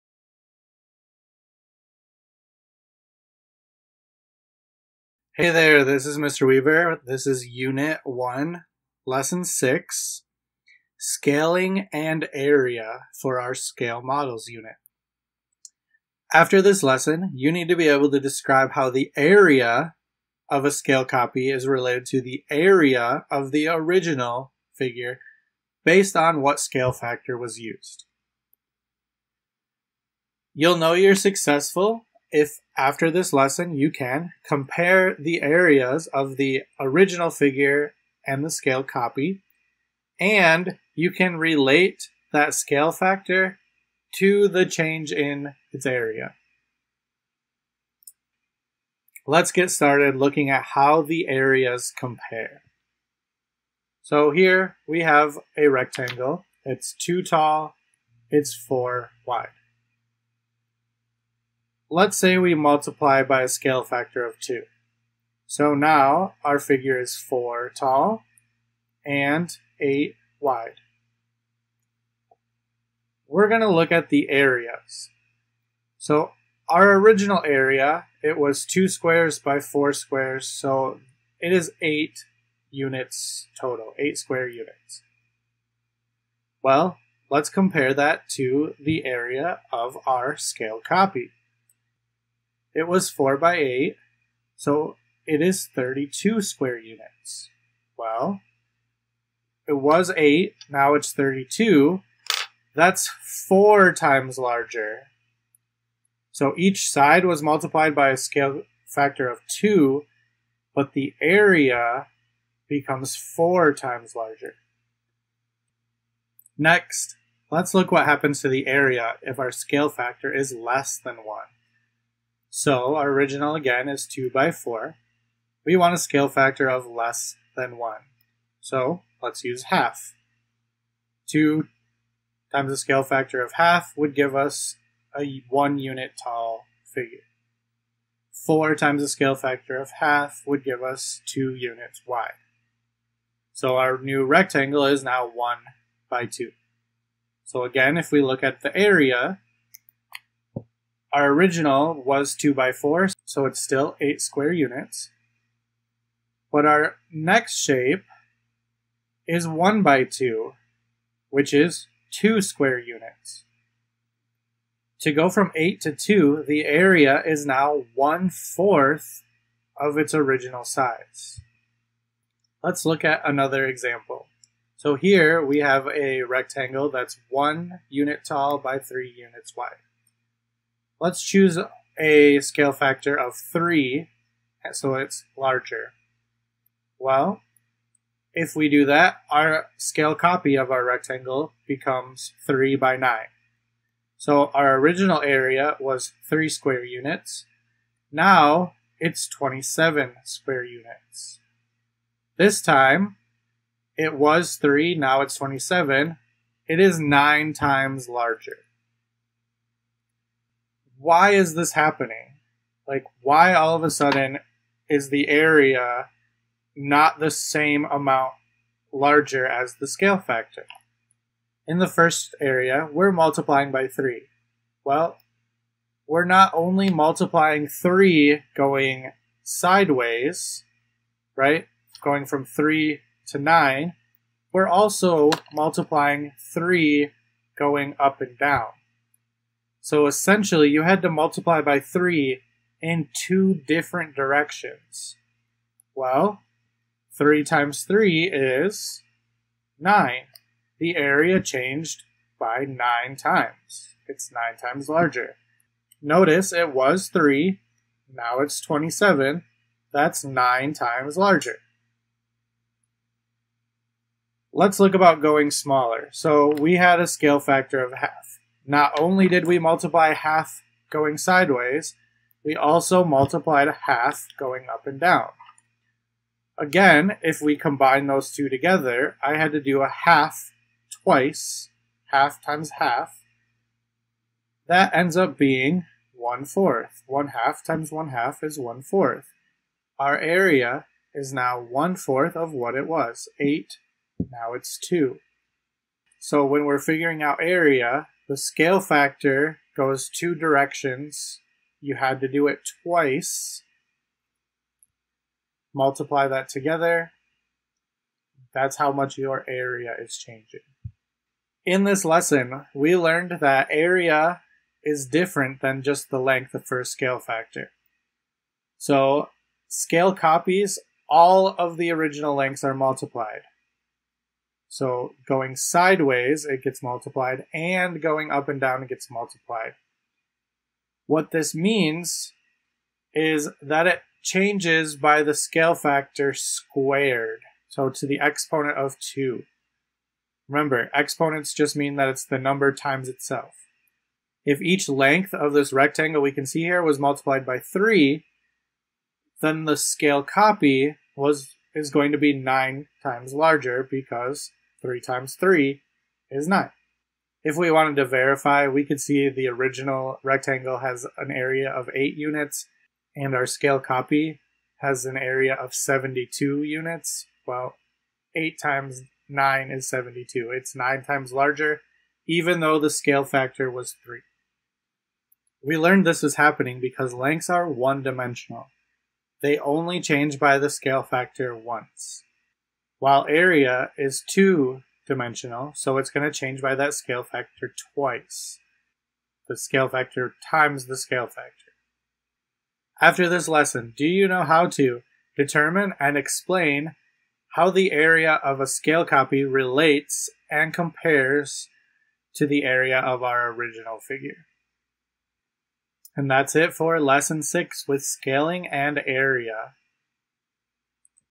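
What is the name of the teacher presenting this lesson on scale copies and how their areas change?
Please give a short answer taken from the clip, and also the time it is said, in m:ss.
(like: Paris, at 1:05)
Mr. Weaver, at 0:06.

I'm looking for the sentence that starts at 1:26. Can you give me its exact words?
Well, let's compare that to the area of our scale copy.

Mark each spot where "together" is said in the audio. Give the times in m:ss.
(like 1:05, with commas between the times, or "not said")
4:38, 5:06.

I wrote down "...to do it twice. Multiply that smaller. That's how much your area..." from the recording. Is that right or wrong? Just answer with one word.
wrong.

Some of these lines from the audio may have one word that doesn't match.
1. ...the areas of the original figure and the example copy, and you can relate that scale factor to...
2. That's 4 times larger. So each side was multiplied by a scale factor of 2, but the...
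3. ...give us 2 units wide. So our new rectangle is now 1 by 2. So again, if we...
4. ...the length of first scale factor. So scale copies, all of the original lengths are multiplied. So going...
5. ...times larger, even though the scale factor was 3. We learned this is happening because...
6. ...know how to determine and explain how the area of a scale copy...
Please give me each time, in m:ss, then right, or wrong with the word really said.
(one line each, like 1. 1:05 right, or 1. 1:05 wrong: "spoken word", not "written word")
1. 0:35 wrong: "scale", not "example"
2. 1:42 right
3. 2:20 right
4. 5:16 right
5. 6:11 right
6. 6:34 right.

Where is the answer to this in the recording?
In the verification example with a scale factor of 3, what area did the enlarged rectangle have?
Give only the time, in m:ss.
6:05.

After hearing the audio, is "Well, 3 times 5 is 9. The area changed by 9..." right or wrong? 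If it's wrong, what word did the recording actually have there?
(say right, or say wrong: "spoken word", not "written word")
wrong: "3", not "5".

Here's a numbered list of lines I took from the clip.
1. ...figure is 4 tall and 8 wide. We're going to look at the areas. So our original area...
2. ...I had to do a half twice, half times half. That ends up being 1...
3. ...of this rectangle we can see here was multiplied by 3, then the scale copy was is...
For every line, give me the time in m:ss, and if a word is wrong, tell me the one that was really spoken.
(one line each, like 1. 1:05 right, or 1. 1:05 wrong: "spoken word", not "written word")
1. 1:06 right
2. 4:39 right
3. 5:45 right.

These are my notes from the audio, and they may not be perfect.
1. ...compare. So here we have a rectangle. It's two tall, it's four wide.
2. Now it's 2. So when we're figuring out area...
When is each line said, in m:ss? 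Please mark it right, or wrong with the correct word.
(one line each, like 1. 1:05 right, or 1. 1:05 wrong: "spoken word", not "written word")
1. 0:51 right
2. 4:54 right.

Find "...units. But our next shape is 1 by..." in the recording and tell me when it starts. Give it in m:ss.
2:34.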